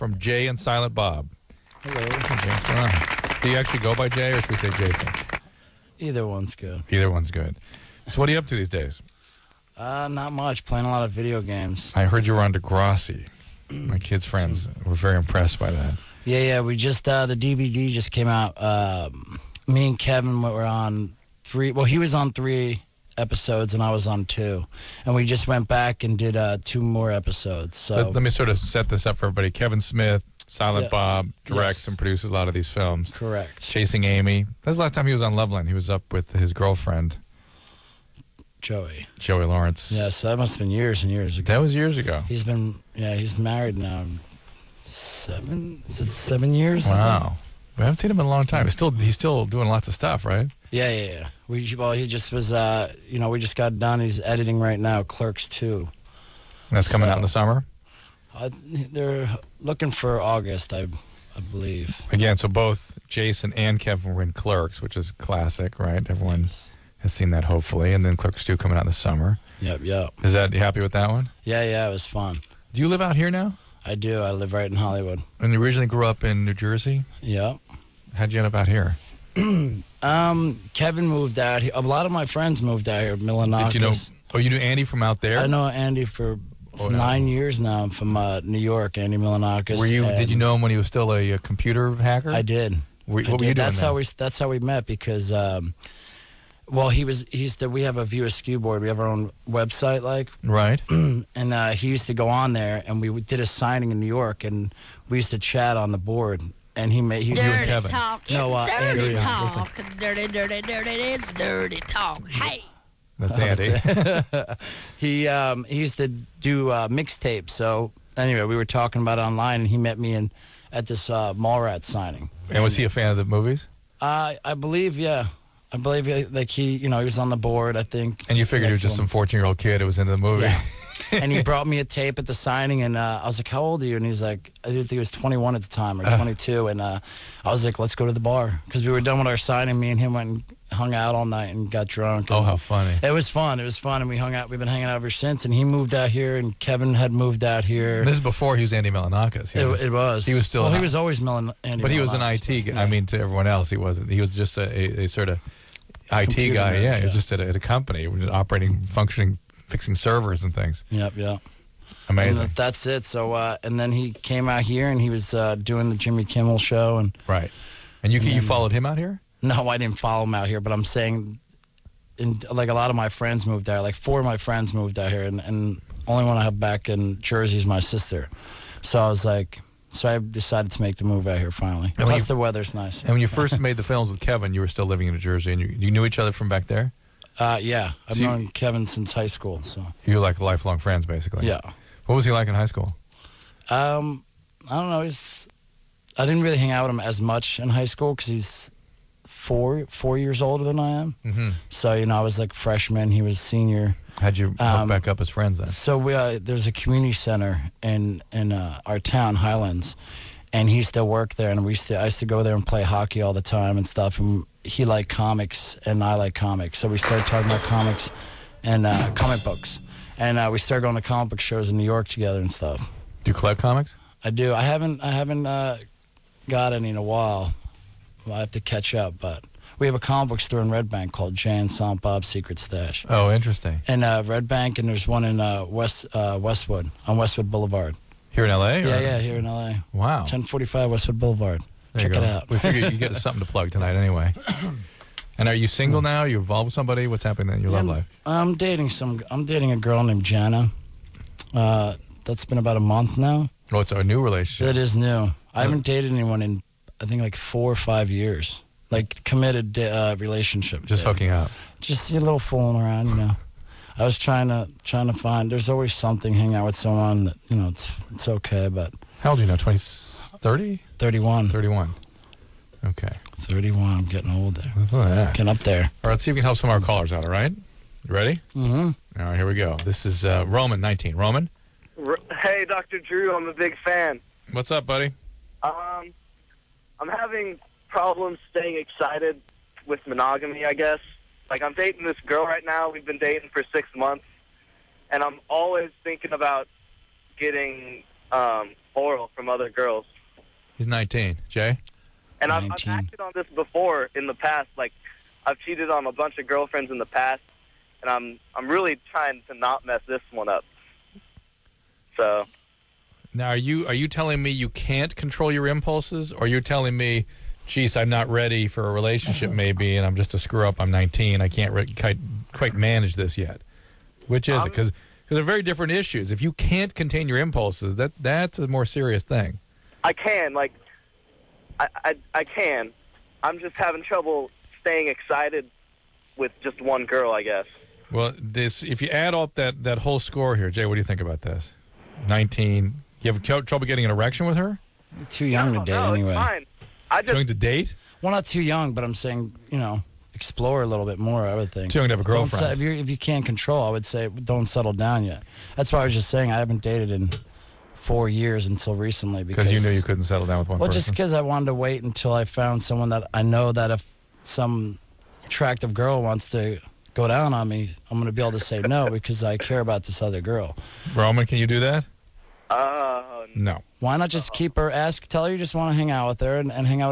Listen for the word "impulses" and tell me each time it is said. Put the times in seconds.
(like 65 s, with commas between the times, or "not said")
315 s, 327 s.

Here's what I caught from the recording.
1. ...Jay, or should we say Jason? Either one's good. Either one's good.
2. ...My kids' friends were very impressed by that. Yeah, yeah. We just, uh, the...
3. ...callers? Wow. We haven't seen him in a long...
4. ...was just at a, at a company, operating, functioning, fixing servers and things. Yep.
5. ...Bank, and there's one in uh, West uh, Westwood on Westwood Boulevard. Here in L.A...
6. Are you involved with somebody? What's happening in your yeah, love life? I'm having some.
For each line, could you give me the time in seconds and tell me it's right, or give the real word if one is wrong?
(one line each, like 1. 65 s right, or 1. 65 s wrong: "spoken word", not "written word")
1. 4 s right
2. 13 s right
3. 46 s wrong: "years", not "callers"
4. 157 s right
5. 234 s right
6. 246 s wrong: "dating", not "having".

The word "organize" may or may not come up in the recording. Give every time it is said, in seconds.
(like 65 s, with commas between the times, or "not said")
not said.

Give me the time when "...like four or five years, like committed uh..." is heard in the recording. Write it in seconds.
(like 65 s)
257 s.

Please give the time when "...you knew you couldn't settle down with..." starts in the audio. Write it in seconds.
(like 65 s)
359 s.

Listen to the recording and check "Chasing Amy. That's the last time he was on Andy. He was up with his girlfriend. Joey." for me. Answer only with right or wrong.
wrong.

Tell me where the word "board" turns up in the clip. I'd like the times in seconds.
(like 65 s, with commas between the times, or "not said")
98 s, 105 s, 127 s.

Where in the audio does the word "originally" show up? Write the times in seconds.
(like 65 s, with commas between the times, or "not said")
75 s.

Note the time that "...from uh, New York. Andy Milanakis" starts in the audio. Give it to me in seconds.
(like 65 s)
87 s.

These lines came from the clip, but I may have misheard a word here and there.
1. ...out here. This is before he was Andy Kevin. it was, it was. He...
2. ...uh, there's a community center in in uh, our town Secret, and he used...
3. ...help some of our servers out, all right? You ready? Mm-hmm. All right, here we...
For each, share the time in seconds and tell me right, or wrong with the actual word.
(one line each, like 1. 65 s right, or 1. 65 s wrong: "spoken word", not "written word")
1. 147 s wrong: "Milonakis", not "Kevin"
2. 206 s wrong: "Highlands", not "Secret"
3. 276 s wrong: "callers", not "servers".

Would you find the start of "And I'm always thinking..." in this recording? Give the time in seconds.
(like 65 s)
295 s.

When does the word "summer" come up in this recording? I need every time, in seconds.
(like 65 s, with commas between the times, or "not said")
57 s, 68 s.